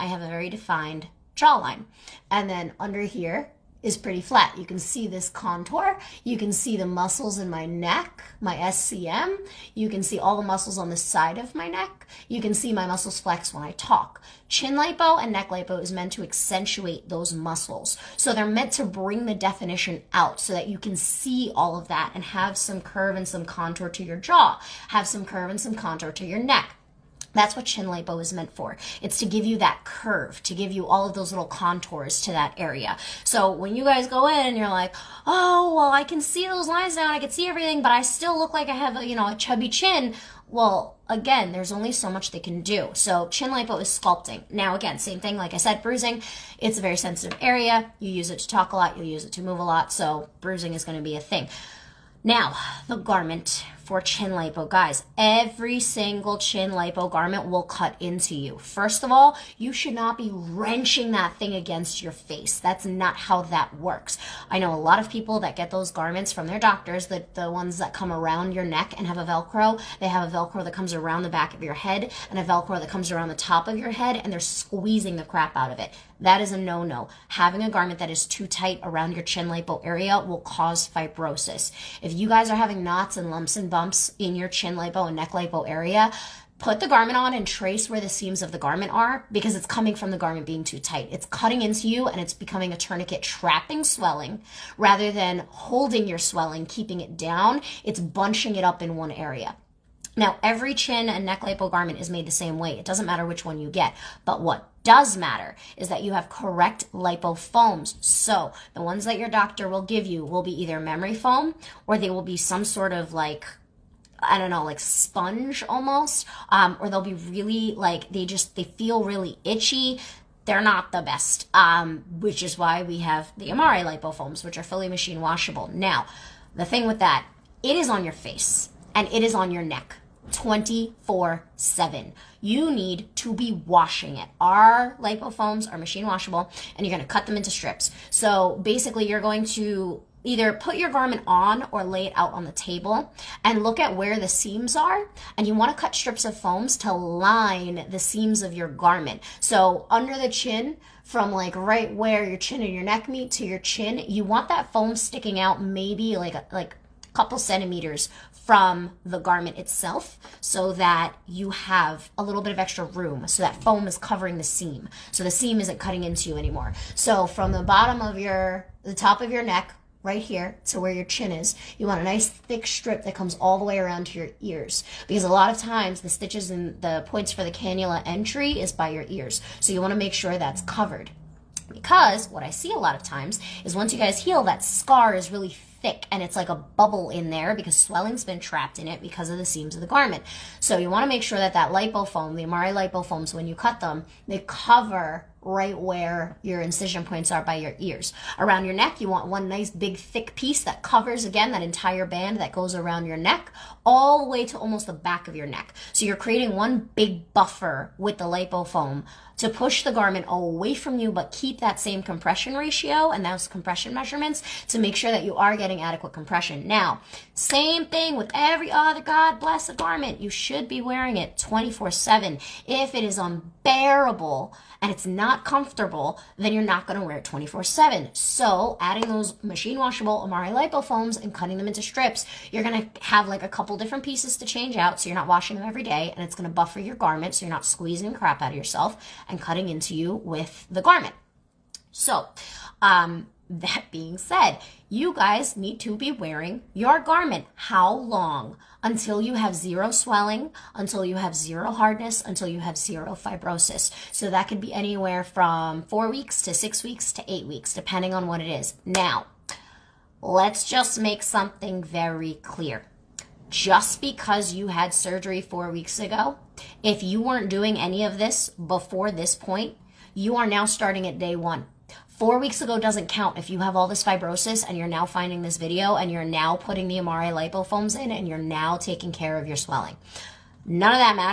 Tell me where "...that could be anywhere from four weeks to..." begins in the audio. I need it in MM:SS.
04:14.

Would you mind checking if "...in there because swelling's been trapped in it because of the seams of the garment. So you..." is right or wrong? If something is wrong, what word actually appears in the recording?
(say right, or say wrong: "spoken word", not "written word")
right.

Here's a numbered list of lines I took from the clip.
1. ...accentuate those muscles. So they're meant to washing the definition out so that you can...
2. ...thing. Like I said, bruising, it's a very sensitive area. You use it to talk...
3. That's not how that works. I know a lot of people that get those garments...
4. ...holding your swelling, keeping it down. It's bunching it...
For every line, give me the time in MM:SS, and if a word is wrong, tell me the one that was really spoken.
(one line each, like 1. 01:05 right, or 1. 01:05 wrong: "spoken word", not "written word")
1. 00:16 wrong: "bring", not "washing"
2. 00:45 right
3. 01:02 right
4. 01:35 right.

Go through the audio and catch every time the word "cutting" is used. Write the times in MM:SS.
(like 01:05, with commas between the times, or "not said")
01:31, 02:45, 03:51, 03:59.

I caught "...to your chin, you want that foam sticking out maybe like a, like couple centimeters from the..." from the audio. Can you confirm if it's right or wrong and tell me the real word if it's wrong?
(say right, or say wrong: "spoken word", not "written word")
right.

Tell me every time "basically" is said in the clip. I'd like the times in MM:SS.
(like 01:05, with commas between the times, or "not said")
02:18.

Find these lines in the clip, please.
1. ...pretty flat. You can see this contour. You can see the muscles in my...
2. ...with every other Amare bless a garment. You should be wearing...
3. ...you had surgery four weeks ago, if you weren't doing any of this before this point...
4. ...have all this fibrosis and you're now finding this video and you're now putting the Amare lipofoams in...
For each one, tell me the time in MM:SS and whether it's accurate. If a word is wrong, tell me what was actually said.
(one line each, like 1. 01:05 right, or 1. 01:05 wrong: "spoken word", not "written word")
1. 00:03 right
2. 03:38 wrong: "God", not "Amare"
3. 04:24 right
4. 04:33 right.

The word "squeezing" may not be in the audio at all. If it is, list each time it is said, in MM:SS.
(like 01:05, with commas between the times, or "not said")
01:14, 03:57.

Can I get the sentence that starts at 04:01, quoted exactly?
So, um, that being said, you guys need to be wearing your garment.